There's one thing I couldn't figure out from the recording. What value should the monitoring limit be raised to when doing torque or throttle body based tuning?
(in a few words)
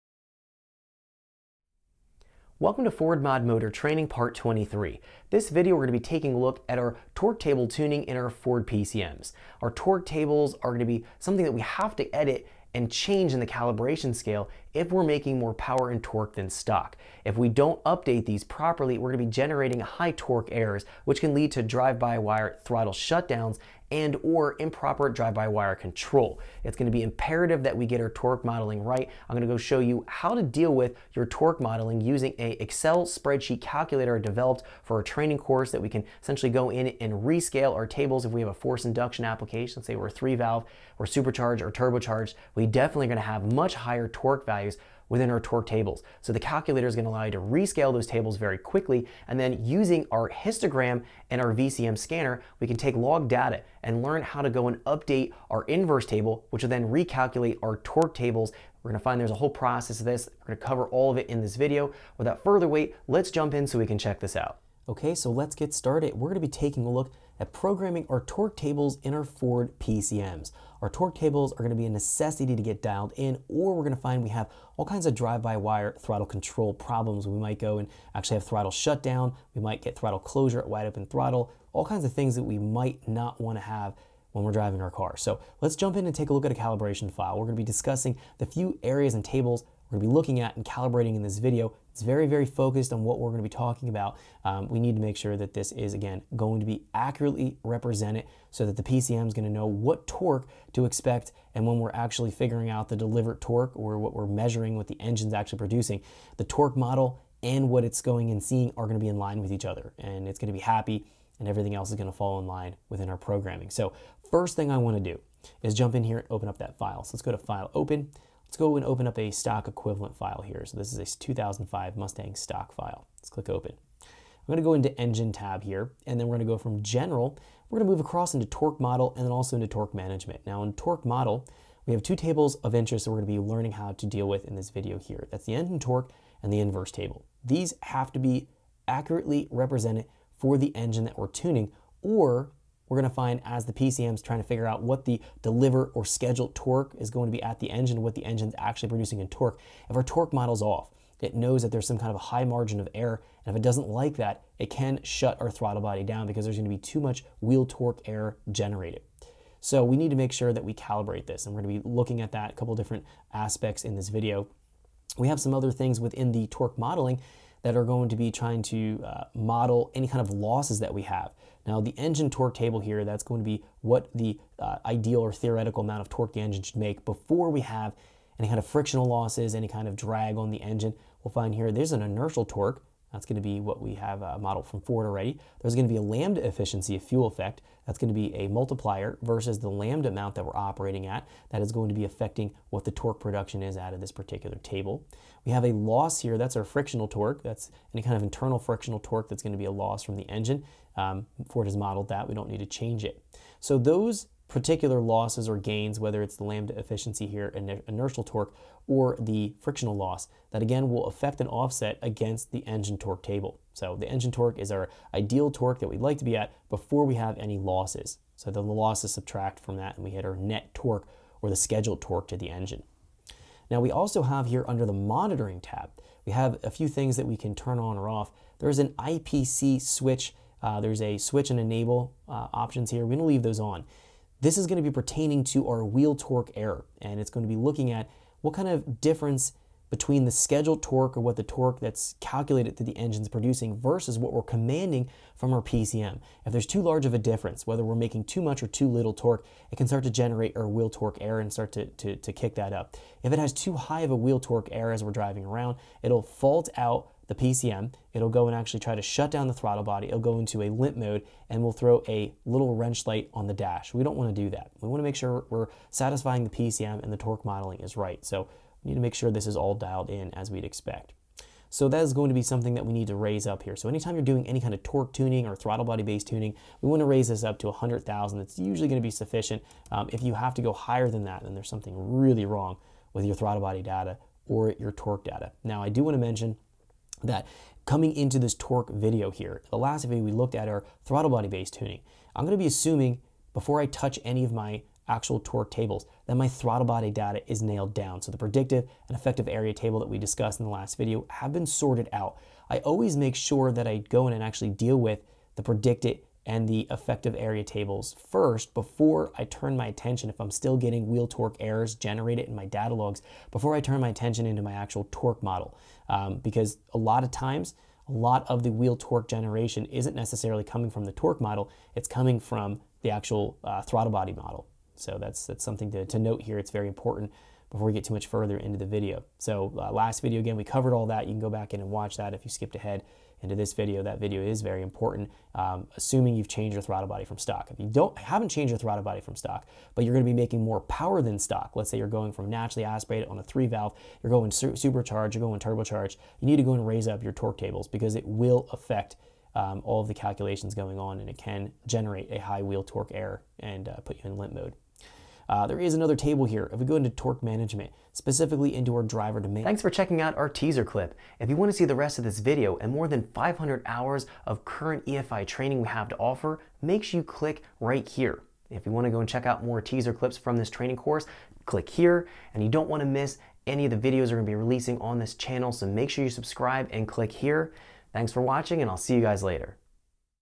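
100,000.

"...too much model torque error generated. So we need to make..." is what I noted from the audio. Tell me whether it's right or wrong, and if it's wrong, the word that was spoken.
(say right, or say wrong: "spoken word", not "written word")
wrong: "wheel", not "model".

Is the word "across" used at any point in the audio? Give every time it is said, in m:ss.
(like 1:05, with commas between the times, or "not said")
2:08.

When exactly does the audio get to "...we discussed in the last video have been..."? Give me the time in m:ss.
5:00.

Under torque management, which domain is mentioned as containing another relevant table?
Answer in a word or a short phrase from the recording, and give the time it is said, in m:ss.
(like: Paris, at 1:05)
driver domain, at 5:59.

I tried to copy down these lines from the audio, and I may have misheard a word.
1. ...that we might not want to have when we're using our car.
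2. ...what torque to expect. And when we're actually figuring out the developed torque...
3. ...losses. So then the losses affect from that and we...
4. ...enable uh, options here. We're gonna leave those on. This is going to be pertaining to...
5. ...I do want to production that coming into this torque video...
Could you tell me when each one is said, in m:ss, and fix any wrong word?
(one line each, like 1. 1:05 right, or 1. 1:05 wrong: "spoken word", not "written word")
1. 1:22 wrong: "driving", not "using"
2. 1:39 wrong: "delivered", not "developed"
3. 3:37 wrong: "subtract", not "affect"
4. 3:51 right
5. 4:45 wrong: "mention", not "production".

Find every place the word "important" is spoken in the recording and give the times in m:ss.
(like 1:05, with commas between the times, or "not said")
5:26, 5:34.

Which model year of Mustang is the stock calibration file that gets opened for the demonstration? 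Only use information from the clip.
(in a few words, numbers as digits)
2005.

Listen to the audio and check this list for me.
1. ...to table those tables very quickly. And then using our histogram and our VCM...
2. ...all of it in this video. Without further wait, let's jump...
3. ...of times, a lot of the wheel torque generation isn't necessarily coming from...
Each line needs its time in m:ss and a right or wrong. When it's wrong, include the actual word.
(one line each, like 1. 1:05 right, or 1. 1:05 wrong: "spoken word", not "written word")
1. 0:47 wrong: "rescale", not "table"
2. 1:00 right
3. 5:17 right.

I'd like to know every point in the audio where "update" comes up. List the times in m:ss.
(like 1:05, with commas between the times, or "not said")
0:17, 0:54.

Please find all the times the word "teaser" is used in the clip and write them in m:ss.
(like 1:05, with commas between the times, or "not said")
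6:00, 6:09.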